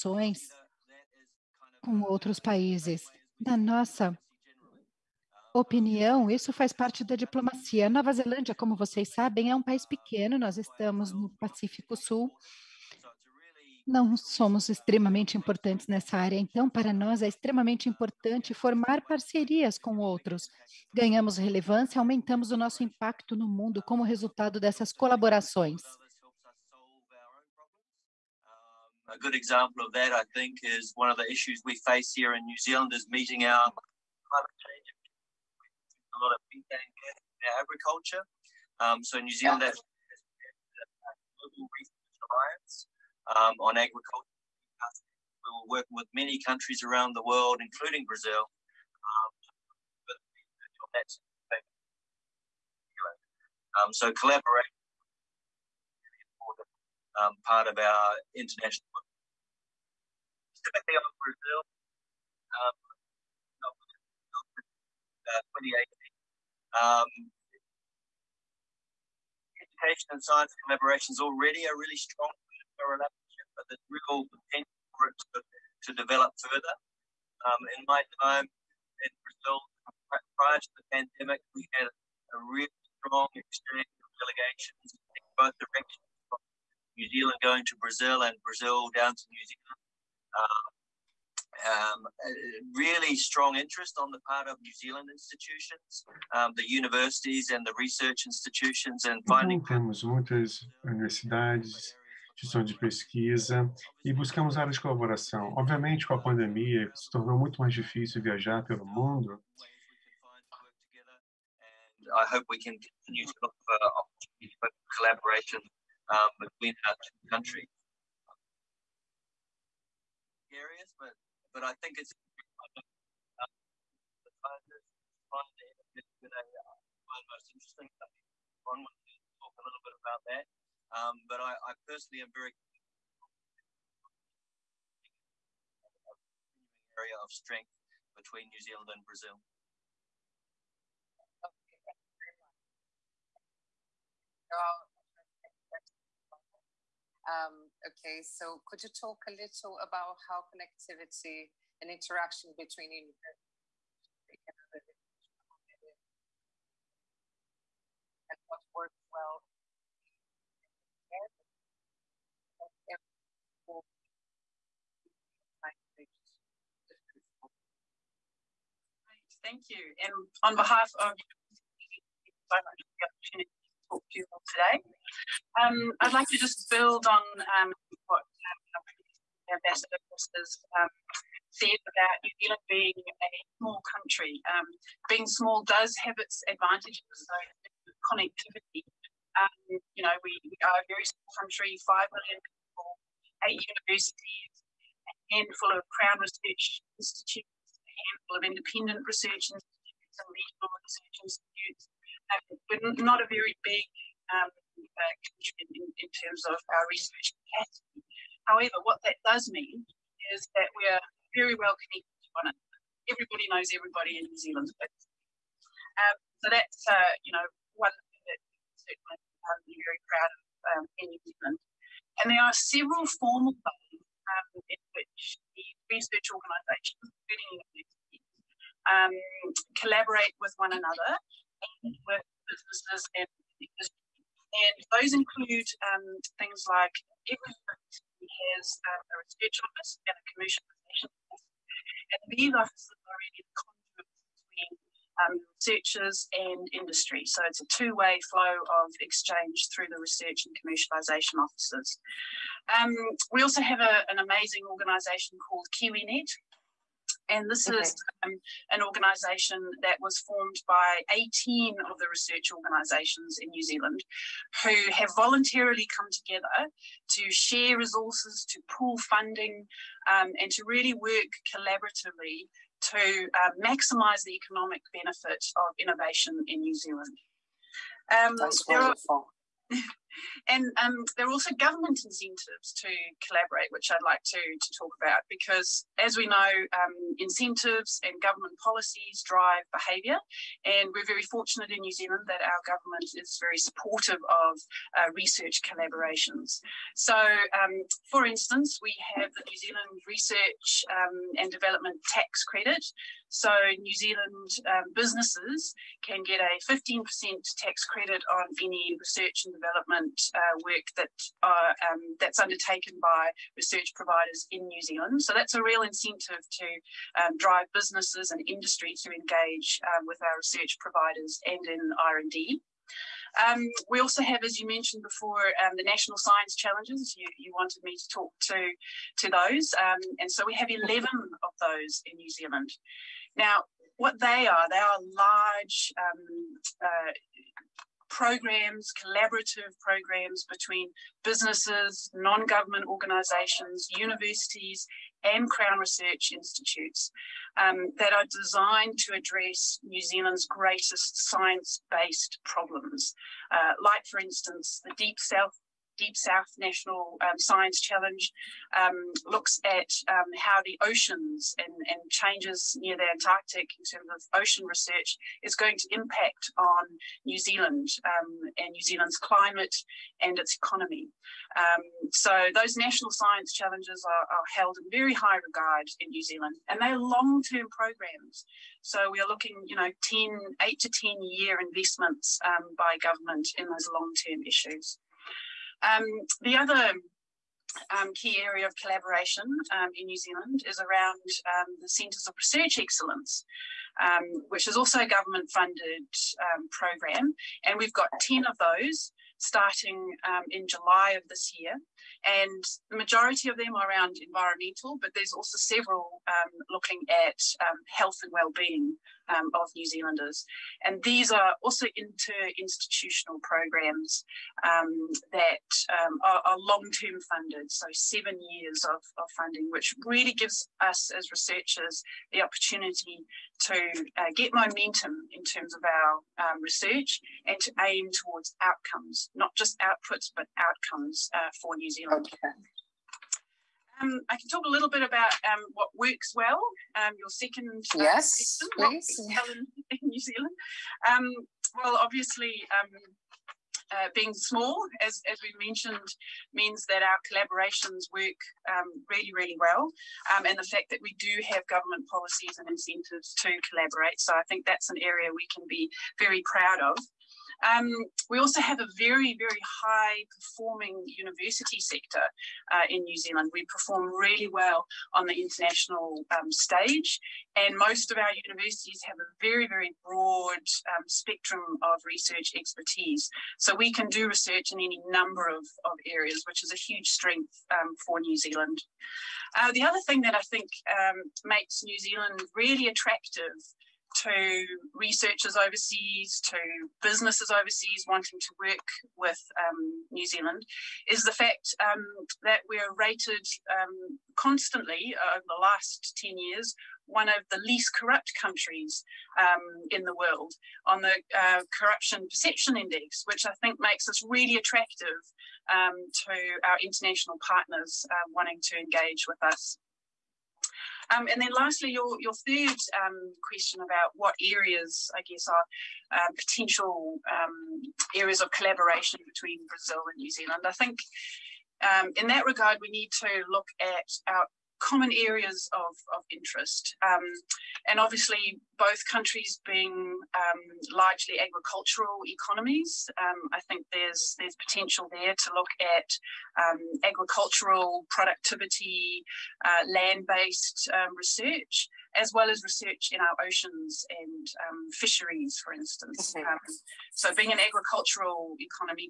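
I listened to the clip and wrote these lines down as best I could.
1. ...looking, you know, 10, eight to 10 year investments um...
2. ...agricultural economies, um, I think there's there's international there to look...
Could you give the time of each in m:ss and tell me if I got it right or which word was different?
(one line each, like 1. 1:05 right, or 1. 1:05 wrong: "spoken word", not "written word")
1. 6:19 right
2. 8:51 wrong: "potential", not "international".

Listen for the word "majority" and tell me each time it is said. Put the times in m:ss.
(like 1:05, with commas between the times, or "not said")
6:42.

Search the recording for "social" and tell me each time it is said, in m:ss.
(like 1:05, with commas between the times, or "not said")
not said.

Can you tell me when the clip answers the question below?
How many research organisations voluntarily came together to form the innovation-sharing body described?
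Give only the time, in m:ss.
4:21.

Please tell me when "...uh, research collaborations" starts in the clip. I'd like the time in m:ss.
4:54.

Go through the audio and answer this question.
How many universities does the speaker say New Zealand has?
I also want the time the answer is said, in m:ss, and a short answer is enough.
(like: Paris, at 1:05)
8, at 3:13.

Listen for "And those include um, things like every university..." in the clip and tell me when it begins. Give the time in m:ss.
3:54.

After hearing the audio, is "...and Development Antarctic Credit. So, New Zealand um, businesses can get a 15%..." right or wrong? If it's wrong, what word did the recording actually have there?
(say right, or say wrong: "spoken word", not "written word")
wrong: "Tax", not "Antarctic".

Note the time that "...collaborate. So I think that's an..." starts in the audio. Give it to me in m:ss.
7:33.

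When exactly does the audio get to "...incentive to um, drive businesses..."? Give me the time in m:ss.
5:15.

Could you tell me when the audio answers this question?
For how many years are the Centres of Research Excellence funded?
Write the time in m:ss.
6:57.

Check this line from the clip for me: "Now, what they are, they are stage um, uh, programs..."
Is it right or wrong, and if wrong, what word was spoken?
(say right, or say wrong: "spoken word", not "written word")
wrong: "large", not "stage".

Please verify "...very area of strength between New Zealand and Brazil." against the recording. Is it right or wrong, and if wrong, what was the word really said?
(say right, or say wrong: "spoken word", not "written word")
right.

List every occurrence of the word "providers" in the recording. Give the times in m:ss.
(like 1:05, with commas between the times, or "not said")
5:13, 5:20.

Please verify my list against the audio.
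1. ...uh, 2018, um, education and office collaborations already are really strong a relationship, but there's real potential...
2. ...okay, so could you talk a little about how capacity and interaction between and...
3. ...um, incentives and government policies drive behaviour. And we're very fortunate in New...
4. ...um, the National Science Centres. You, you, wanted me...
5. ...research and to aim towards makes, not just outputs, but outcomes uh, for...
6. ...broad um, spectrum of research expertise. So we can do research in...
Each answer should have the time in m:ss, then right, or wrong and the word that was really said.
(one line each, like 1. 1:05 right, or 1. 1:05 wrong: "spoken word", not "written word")
1. 1:03 wrong: "science", not "office"
2. 2:27 wrong: "connectivity", not "capacity"
3. 4:46 right
4. 5:25 wrong: "Challenges", not "Centres"
5. 7:06 wrong: "outcomes", not "makes"
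6. 7:50 right.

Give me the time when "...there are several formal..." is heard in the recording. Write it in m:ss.
3:42.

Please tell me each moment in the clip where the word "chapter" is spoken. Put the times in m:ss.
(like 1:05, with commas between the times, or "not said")
not said.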